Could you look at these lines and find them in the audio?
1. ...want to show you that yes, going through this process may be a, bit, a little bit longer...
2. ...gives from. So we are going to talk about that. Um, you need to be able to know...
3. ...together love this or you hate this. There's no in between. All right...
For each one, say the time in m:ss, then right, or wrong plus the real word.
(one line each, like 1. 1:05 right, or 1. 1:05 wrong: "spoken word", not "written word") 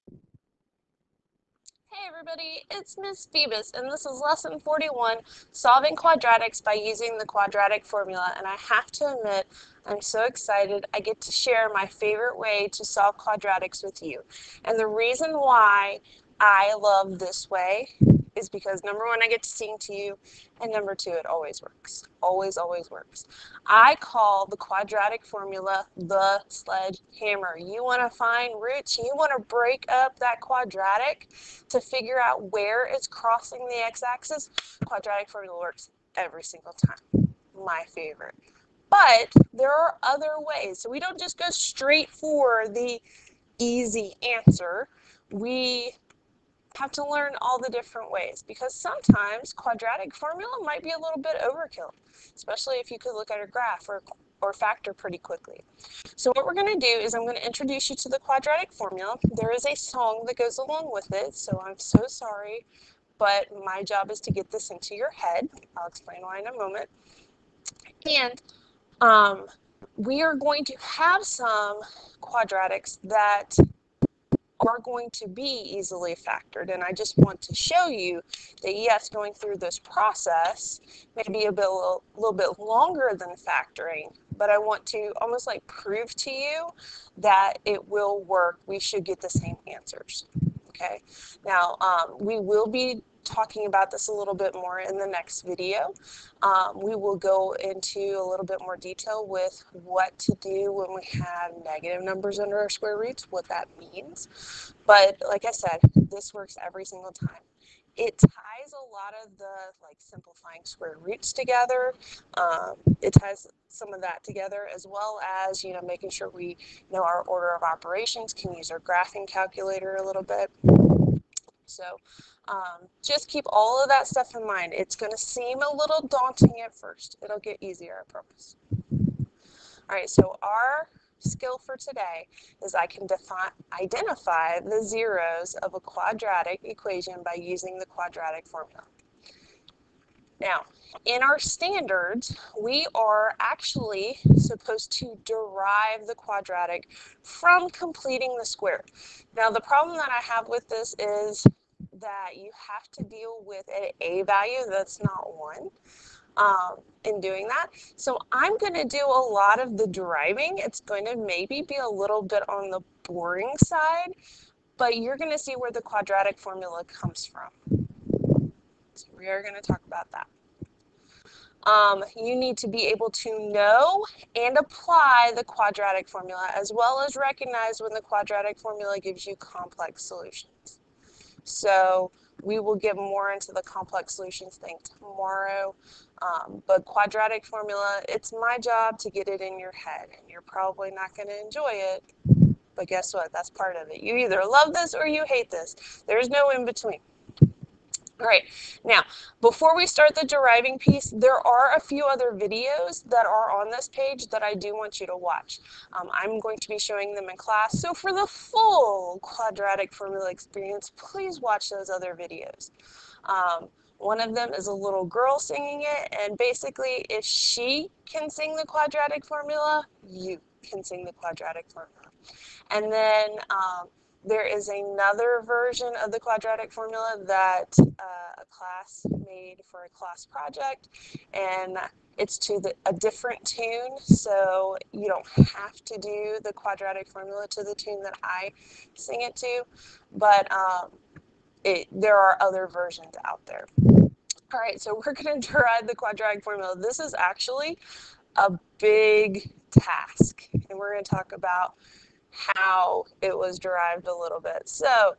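1. 1:17 right
2. 2:46 wrong: "comes", not "gives"
3. 3:14 wrong: "either", not "together".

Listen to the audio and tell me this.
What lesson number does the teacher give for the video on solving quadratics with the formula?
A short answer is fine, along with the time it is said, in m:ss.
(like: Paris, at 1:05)
41, at 0:04.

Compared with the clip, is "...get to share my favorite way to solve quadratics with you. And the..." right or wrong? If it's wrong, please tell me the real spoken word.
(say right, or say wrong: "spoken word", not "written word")
right.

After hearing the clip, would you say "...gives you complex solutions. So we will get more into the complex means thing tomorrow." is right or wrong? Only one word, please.
wrong.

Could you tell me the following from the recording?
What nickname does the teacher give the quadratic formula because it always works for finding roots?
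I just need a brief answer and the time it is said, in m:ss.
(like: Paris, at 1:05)
the sledgehammer, at 0:25.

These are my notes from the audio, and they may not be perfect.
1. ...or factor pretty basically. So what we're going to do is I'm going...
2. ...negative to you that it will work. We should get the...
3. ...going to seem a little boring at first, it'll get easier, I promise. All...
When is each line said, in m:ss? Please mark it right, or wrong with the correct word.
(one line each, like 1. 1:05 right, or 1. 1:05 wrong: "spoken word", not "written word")
1. 0:54 wrong: "quickly", not "basically"
2. 1:25 wrong: "prove", not "negative"
3. 2:04 wrong: "daunting", not "boring".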